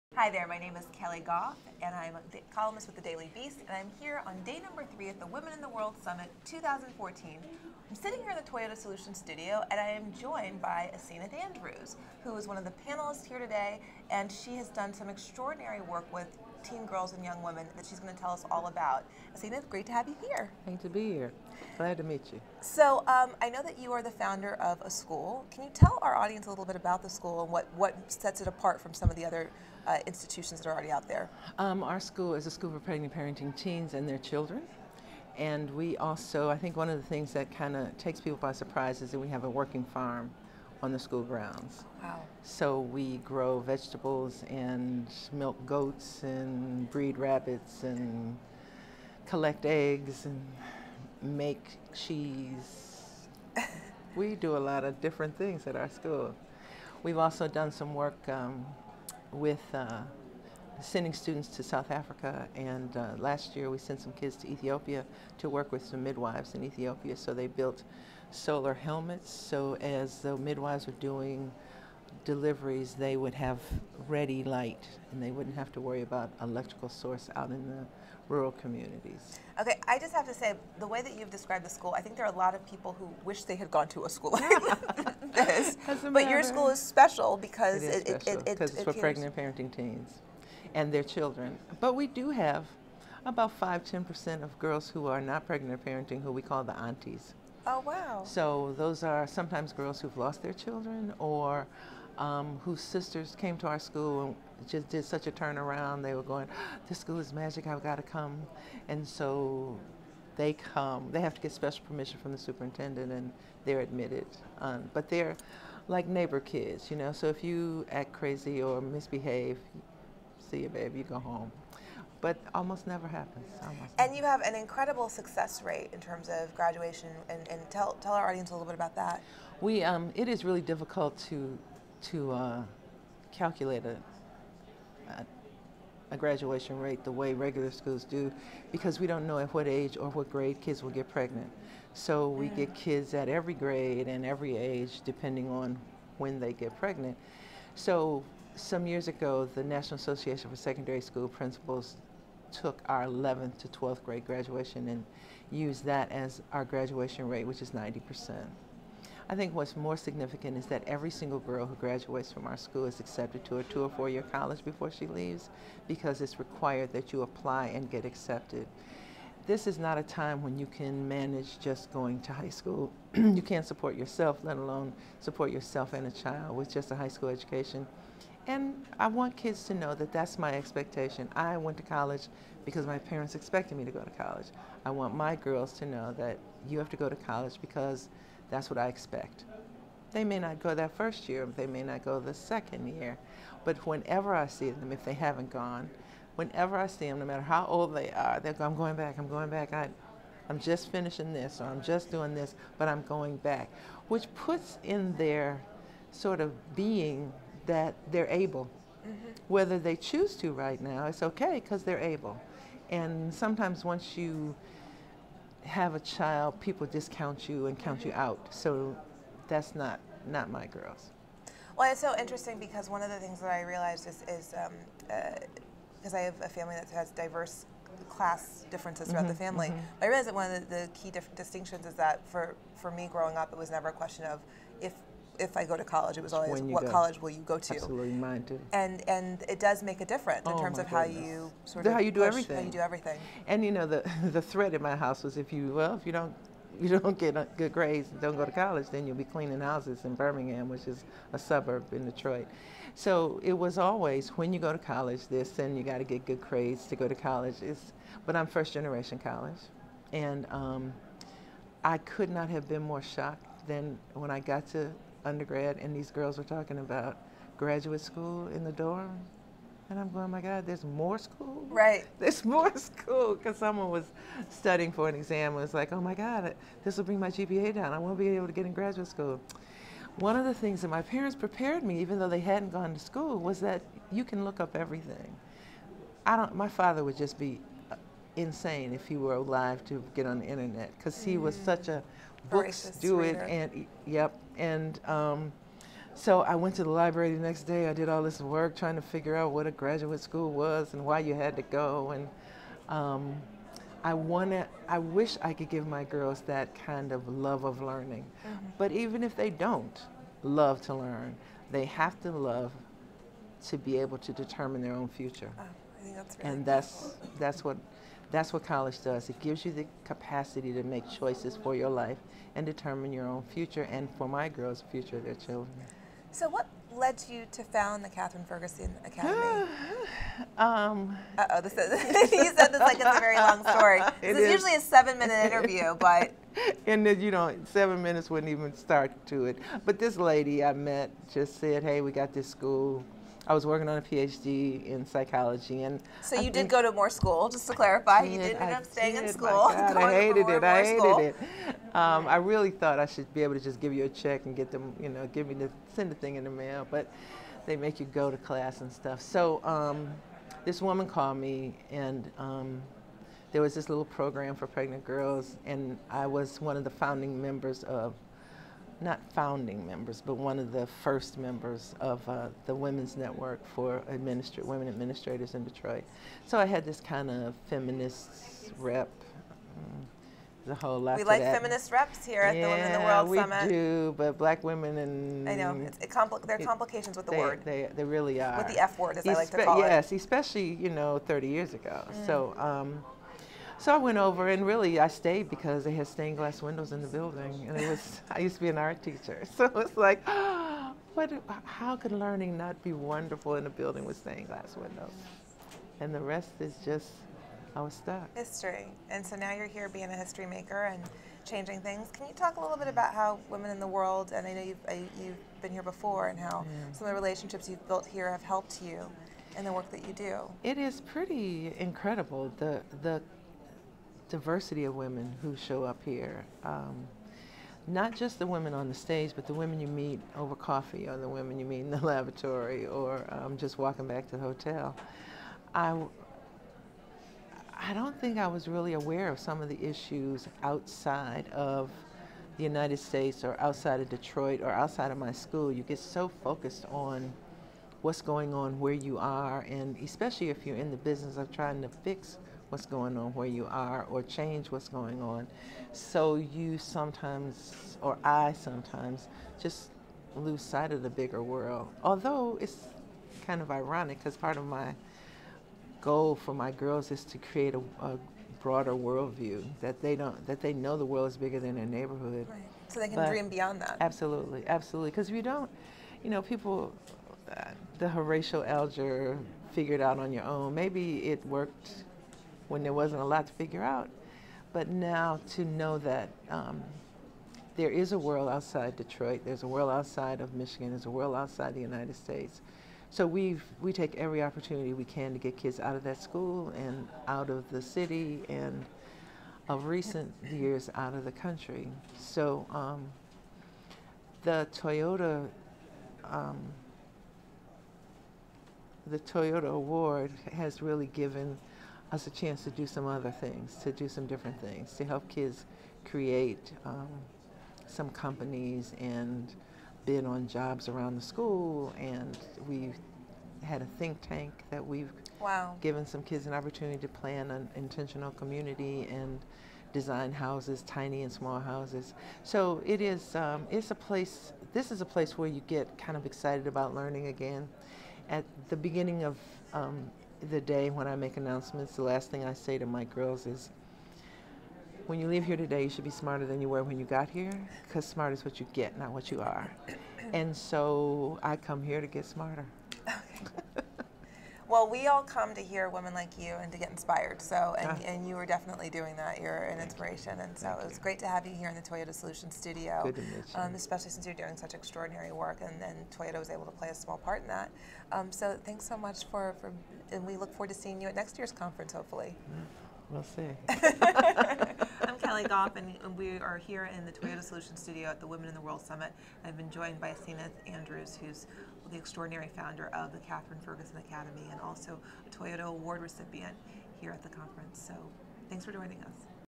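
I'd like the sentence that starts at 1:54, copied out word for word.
Um, but they're like neighbor kids, you know.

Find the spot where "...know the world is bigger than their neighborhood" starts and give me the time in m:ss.
7:50.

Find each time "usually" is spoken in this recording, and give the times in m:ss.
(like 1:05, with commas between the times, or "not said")
5:34.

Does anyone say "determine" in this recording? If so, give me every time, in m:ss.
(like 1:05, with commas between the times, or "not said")
5:14, 5:22.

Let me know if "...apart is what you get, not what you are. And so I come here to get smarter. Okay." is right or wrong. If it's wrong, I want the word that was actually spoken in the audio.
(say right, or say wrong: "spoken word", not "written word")
wrong: "smart", not "apart".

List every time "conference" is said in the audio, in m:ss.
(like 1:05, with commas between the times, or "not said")
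9:31, 9:47.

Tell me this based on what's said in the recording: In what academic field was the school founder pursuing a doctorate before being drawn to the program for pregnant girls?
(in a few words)
psychology.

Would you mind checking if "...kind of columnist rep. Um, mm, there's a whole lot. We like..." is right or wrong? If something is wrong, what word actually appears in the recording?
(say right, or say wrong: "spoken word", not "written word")
wrong: "feminist", not "columnist".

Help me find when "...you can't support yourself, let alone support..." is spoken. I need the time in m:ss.
2:53.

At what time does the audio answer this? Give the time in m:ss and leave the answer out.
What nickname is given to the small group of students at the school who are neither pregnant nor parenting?
1:36.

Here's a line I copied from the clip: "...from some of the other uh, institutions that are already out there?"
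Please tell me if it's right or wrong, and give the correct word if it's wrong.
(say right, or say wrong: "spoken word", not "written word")
right.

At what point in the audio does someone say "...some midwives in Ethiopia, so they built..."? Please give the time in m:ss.
1:05.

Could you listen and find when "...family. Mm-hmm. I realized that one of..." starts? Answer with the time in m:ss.
3:49.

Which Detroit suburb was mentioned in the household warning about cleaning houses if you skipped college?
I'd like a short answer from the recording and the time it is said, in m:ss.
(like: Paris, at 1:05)
Birmingham, at 4:10.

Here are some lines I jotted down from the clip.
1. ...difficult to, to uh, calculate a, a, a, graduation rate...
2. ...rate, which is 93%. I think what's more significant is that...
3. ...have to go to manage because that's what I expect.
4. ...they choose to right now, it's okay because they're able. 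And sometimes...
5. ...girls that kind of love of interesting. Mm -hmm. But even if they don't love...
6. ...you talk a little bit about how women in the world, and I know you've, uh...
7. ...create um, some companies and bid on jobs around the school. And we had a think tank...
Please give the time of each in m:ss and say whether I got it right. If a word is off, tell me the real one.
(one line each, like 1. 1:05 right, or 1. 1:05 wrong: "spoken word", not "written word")
1. 2:10 right
2. 2:37 wrong: "90", not "93"
3. 3:06 wrong: "college", not "manage"
4. 3:29 right
5. 5:06 wrong: "learning", not "interesting"
6. 6:52 right
7. 8:36 right.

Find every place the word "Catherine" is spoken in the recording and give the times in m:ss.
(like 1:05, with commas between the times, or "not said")
5:28, 9:43.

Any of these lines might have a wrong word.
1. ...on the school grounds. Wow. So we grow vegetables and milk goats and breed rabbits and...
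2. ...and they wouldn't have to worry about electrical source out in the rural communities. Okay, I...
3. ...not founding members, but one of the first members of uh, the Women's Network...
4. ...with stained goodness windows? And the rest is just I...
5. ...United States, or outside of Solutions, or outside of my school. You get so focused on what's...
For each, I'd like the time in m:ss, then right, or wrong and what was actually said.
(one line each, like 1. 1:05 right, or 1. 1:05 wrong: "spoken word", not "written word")
1. 0:40 right
2. 1:15 right
3. 6:09 right
4. 6:44 wrong: "glass", not "goodness"
5. 7:22 wrong: "Detroit", not "Solutions".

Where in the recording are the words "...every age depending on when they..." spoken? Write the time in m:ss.
2:24.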